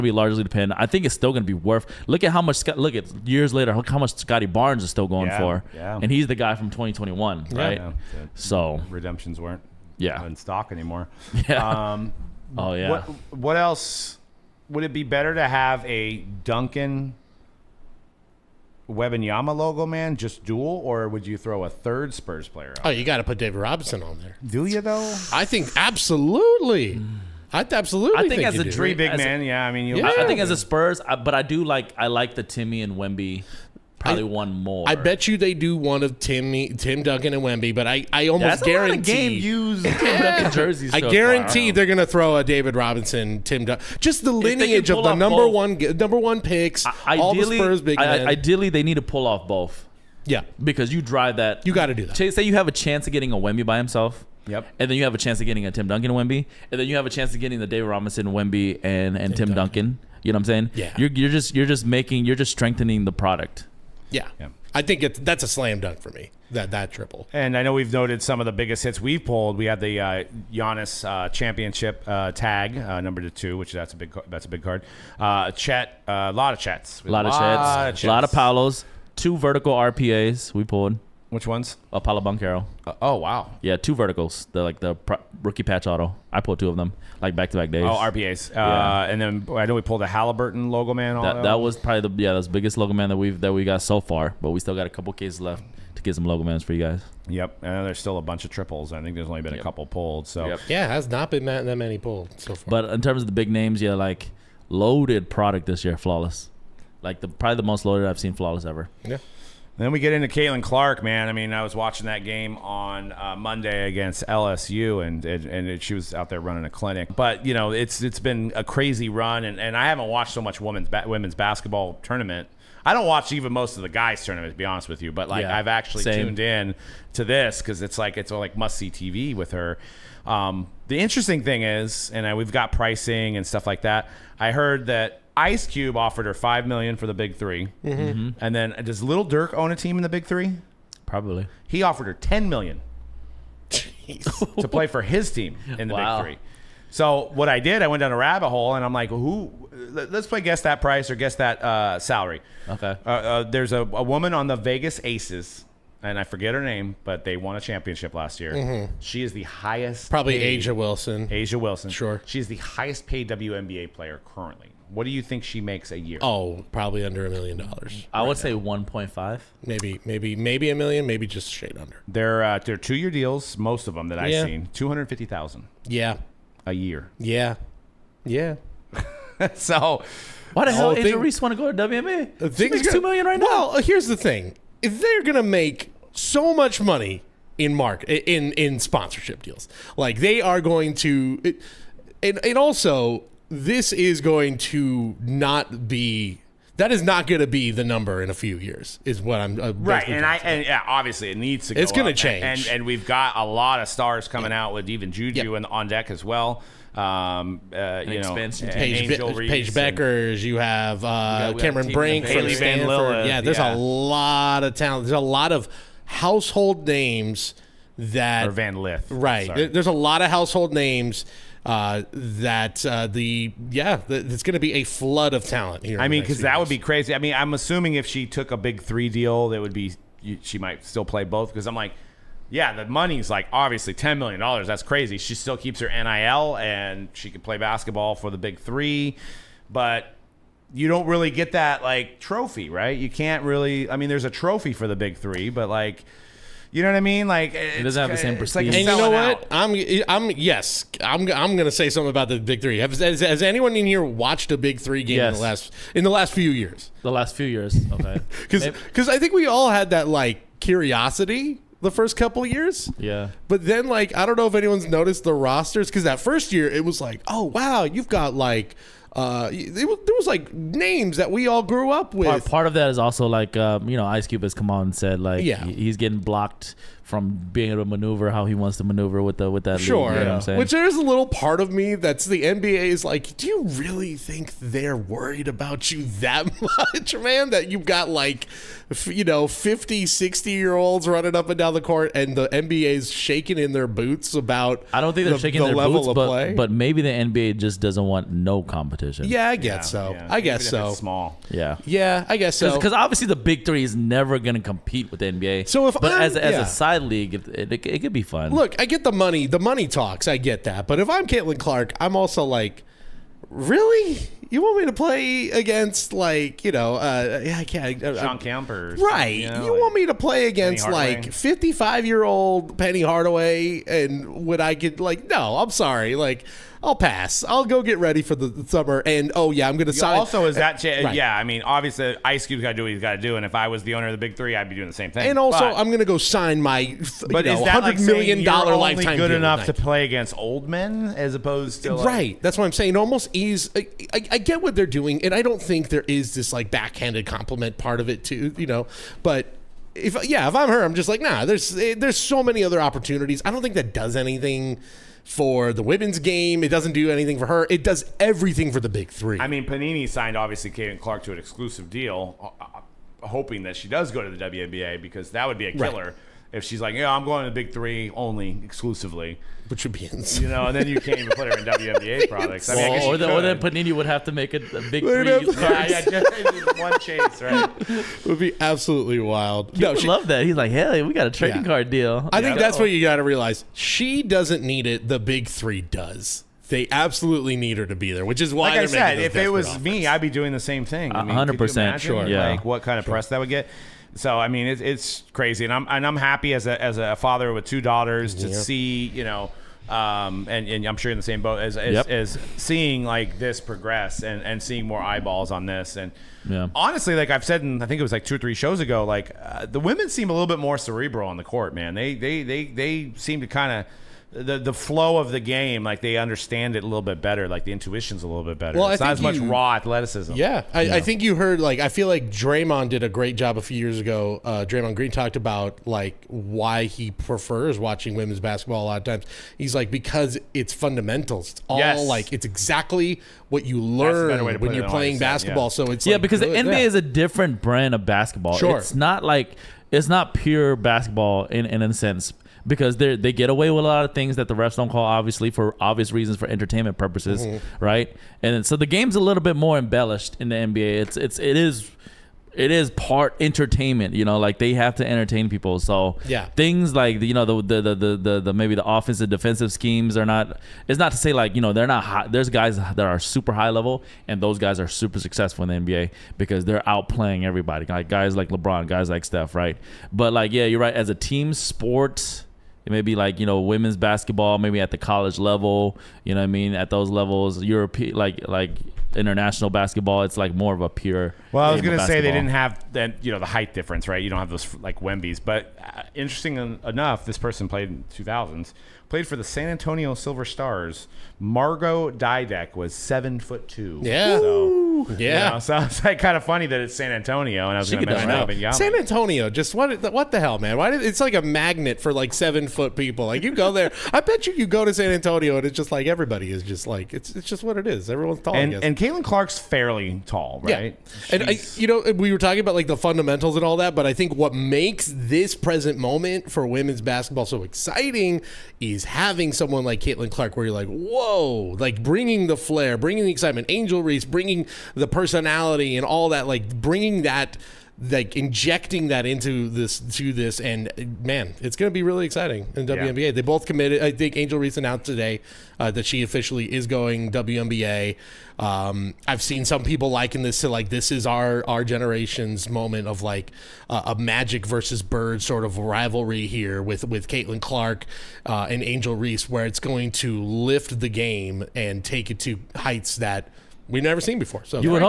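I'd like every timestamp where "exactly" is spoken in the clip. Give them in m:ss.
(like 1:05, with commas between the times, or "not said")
7:12.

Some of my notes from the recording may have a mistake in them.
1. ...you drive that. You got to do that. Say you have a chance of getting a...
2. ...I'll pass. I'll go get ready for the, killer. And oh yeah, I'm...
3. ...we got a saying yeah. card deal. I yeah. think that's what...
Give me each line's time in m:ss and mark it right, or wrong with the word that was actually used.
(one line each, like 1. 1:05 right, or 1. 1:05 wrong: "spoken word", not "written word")
1. 0:50 right
2. 5:26 wrong: "summer", not "killer"
3. 6:21 wrong: "trading", not "saying".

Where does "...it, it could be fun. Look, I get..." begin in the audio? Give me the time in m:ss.
5:07.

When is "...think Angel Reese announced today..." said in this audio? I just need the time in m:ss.
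8:54.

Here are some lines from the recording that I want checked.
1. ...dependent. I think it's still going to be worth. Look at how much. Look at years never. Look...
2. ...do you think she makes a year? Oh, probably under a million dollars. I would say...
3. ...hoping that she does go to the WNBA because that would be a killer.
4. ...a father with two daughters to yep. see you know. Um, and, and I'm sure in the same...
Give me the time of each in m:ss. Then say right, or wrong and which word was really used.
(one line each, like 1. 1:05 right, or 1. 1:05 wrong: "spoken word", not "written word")
1. 0:00 wrong: "later", not "never"
2. 2:45 right
3. 6:03 right
4. 6:36 right.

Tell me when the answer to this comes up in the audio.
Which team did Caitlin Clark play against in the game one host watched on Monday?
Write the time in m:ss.
1:54.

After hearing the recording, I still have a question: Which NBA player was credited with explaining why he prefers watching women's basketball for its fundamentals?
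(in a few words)
Draymond Green.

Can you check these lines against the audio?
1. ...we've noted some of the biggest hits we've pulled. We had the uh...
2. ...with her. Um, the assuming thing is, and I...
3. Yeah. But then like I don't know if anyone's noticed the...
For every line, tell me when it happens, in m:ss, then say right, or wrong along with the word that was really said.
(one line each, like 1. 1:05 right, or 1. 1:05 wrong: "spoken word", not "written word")
1. 1:07 right
2. 2:09 wrong: "interesting", not "assuming"
3. 4:22 right.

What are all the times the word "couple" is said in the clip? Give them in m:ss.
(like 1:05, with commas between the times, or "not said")
1:34, 1:39, 4:22.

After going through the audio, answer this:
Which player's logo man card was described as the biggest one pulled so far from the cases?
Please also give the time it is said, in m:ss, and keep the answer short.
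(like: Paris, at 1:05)
Haliburton, at 1:30.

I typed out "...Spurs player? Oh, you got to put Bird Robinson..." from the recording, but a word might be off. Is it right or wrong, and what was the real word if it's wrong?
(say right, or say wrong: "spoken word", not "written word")
wrong: "David", not "Bird".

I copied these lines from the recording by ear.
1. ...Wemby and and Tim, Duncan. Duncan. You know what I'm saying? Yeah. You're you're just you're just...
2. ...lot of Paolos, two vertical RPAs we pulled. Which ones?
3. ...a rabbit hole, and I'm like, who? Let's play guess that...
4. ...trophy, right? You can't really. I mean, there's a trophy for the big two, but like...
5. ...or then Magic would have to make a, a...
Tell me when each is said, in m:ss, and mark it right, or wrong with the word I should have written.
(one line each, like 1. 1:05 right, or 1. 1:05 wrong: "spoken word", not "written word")
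1. 0:58 right
2. 1:18 right
3. 2:28 right
4. 4:02 wrong: "three", not "two"
5. 6:13 wrong: "Panini", not "Magic".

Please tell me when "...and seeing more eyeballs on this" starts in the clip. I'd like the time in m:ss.
6:44.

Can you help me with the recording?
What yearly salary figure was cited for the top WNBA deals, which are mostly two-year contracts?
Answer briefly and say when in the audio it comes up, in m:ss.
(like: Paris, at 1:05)
250,000, at 2:54.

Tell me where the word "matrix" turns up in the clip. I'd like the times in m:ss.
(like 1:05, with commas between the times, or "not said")
not said.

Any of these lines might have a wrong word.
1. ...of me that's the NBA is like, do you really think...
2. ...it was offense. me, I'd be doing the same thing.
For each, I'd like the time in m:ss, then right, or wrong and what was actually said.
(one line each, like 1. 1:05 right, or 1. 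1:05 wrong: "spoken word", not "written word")
1. 4:41 right
2. 6:29 right.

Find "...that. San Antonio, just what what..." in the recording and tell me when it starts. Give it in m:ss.
8:18.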